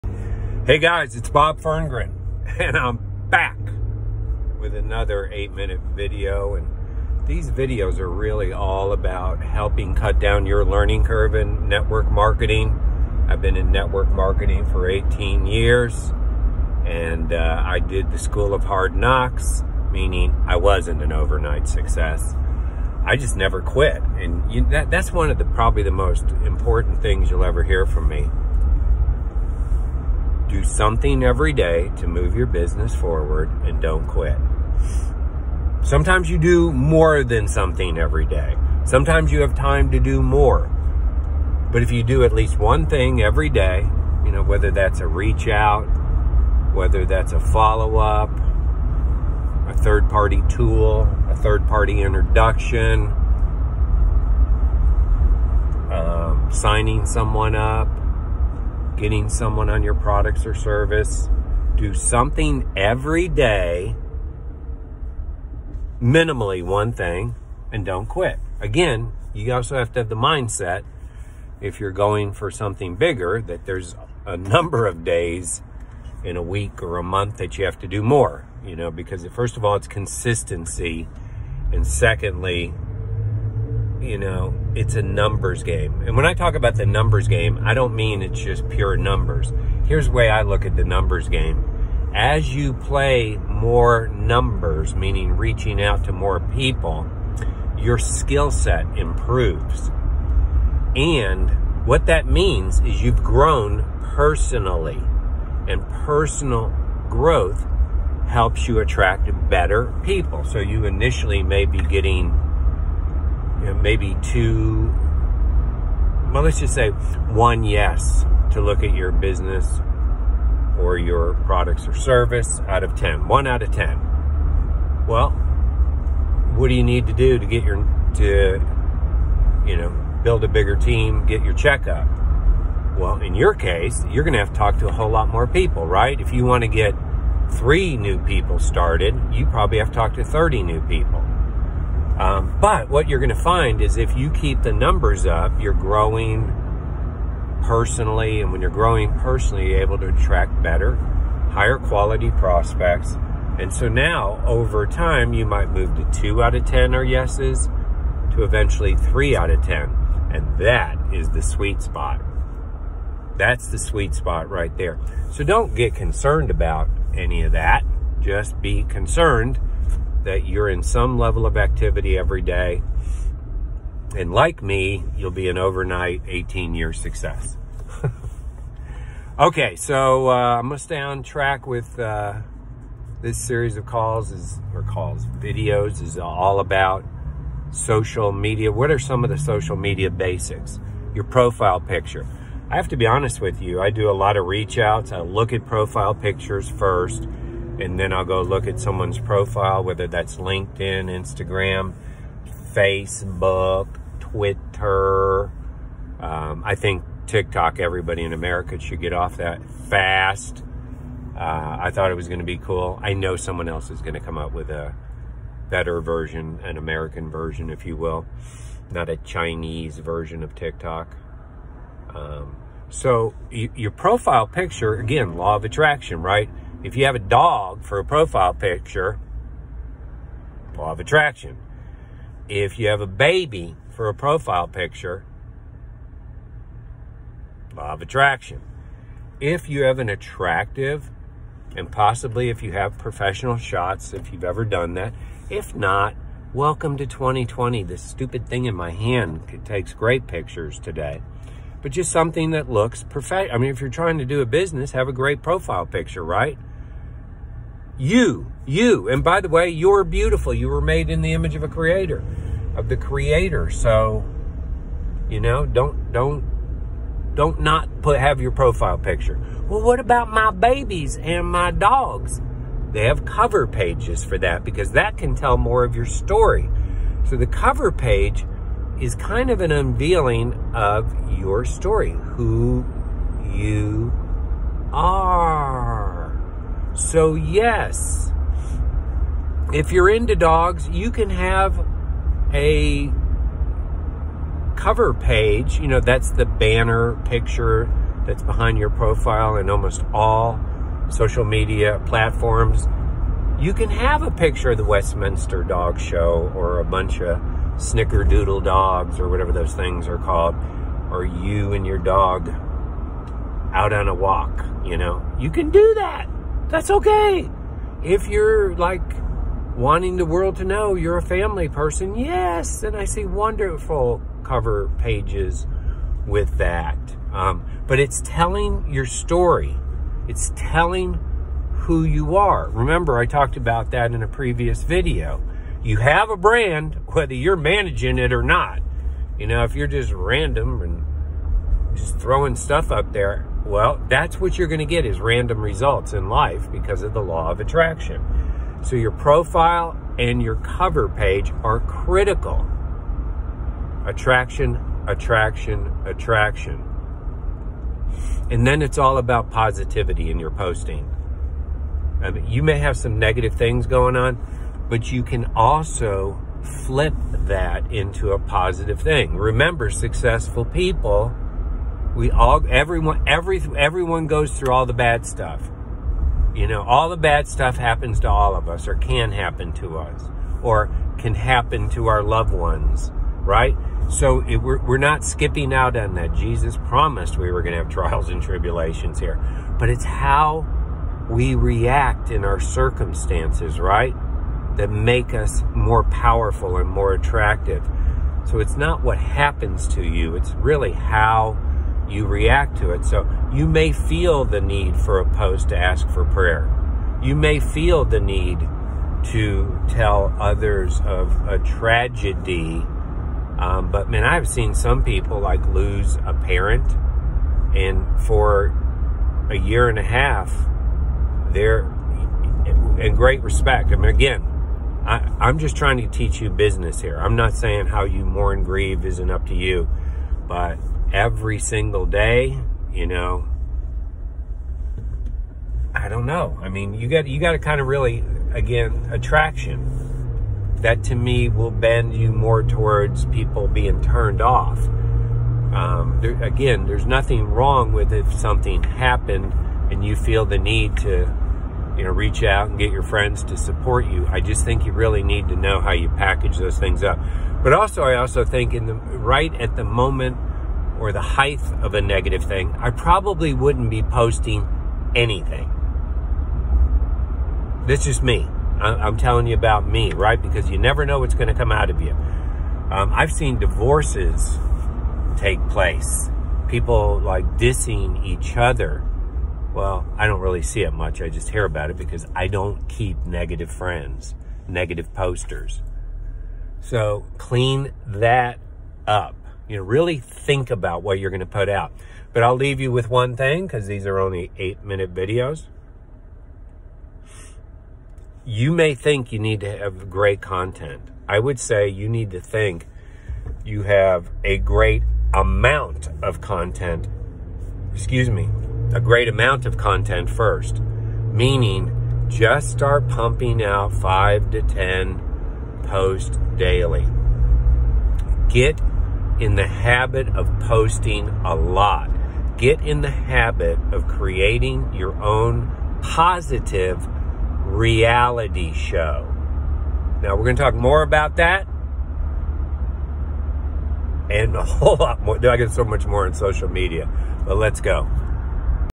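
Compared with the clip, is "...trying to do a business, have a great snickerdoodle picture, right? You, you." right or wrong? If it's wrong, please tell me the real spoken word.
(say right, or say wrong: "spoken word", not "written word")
wrong: "profile", not "snickerdoodle".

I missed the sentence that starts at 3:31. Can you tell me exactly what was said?
Uh, I thought it was going to be cool.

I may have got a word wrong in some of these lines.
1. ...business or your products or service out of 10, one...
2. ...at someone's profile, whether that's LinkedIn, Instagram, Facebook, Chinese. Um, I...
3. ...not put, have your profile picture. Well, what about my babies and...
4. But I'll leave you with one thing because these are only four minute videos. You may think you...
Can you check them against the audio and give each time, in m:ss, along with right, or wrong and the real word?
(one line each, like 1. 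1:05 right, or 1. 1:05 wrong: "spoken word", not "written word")
1. 1:59 right
2. 3:18 wrong: "Twitter", not "Chinese"
3. 4:27 right
4. 8:12 wrong: "eight", not "four".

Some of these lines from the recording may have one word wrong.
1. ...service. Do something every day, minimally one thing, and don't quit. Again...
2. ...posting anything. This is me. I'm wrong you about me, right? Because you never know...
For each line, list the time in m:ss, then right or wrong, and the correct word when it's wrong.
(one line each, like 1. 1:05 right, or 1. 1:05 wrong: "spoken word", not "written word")
1. 1:00 right
2. 7:44 wrong: "telling", not "wrong".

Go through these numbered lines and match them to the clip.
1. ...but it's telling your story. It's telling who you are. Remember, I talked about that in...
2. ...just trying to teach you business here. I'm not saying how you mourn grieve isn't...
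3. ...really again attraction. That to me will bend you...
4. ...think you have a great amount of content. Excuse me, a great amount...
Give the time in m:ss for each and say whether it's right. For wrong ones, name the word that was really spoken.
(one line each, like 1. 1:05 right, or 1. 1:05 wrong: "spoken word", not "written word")
1. 5:27 right
2. 7:05 right
3. 7:17 right
4. 8:22 right.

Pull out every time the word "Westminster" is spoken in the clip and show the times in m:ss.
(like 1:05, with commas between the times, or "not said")
5:04.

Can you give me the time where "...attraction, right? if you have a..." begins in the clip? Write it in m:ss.
3:45.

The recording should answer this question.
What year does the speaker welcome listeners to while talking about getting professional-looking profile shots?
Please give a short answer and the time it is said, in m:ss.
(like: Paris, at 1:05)
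2020, at 4:07.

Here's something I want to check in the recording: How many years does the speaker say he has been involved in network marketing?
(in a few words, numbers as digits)
18.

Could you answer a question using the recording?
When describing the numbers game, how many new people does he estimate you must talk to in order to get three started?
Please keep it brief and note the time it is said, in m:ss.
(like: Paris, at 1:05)
30, at 2:20.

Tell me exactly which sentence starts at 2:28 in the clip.
And when you're growing personally, you're able to attract better, higher quality prospects.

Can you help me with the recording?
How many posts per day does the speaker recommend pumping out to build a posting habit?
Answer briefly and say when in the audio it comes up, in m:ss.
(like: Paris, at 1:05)
5 to 10, at 8:33.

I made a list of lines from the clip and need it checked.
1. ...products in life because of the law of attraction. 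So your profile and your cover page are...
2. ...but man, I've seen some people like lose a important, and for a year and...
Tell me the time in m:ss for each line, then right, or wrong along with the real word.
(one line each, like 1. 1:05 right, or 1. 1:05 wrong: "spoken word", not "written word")
1. 5:45 wrong: "results", not "products"
2. 6:53 wrong: "parent", not "important".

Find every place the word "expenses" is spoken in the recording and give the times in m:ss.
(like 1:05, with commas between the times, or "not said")
not said.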